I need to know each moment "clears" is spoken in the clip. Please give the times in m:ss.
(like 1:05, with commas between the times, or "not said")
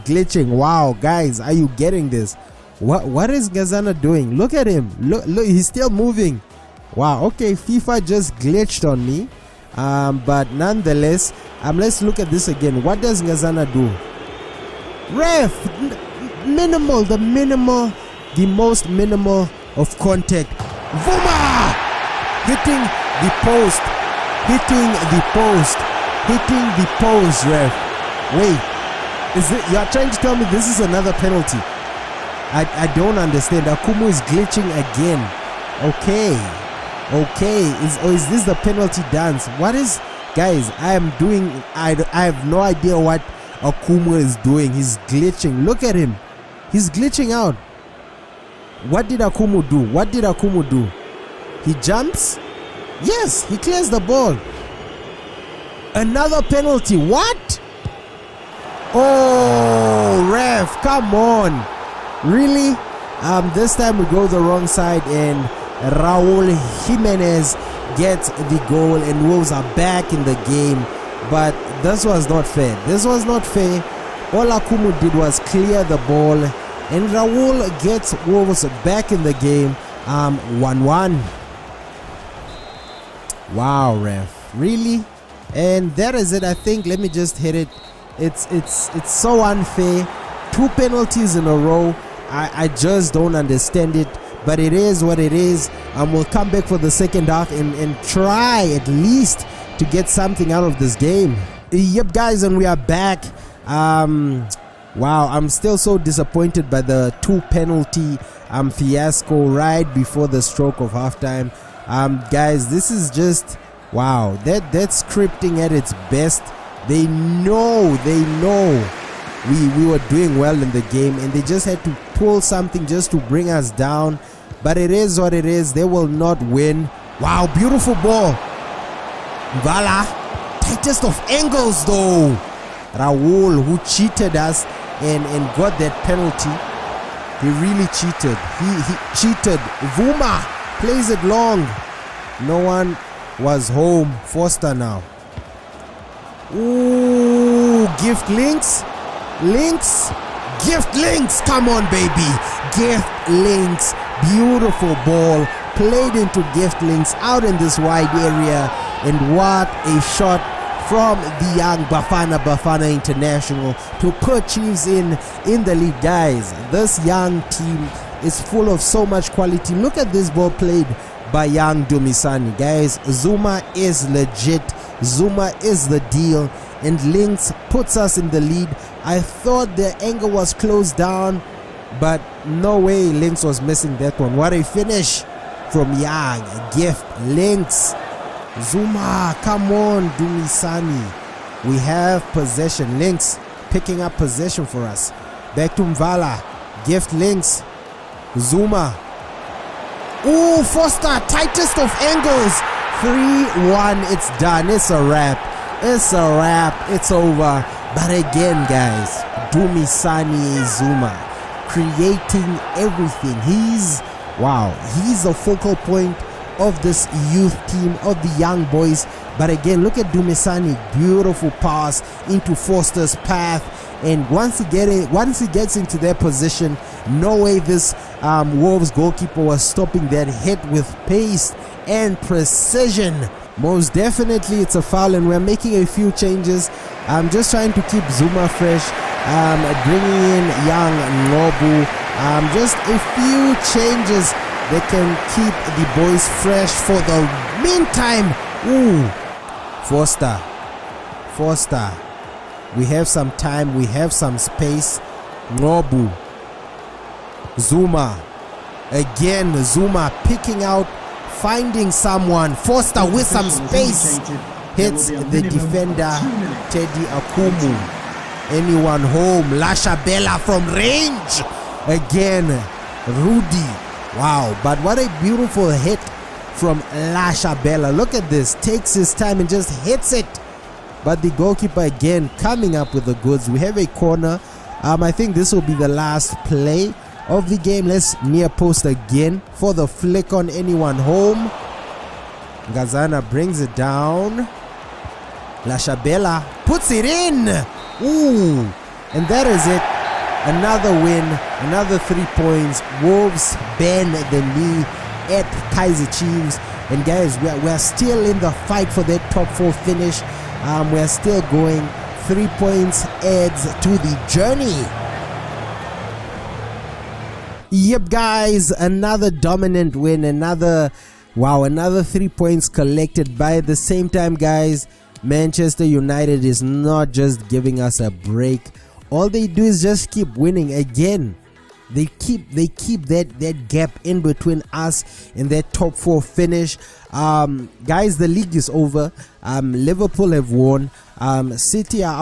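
0:53, 1:15.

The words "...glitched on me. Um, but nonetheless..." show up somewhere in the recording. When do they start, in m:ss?
0:08.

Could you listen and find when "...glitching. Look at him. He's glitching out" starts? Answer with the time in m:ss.
0:45.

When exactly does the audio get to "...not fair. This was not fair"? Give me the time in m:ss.
1:12.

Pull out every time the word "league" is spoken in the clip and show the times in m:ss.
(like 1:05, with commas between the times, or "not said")
2:45, 5:38.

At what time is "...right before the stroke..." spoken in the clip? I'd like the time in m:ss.
1:49.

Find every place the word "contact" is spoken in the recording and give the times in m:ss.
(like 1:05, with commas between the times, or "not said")
0:19.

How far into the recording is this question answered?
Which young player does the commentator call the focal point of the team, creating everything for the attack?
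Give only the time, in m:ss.
3:29.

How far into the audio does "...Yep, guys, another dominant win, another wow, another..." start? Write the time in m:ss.
5:17.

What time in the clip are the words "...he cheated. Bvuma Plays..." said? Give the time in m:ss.
2:18.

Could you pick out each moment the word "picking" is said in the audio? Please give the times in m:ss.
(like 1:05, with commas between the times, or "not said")
3:13, 4:20.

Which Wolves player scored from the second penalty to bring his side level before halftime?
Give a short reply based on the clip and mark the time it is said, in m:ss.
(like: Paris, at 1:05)
Raul Jimenez, at 1:05.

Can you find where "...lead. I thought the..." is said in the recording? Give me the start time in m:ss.
2:58.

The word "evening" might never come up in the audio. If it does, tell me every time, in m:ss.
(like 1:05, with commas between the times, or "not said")
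not said.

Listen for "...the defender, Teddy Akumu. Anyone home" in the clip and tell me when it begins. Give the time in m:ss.
4:25.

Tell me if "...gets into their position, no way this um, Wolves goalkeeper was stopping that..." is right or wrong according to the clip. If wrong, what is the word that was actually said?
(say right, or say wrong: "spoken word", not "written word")
right.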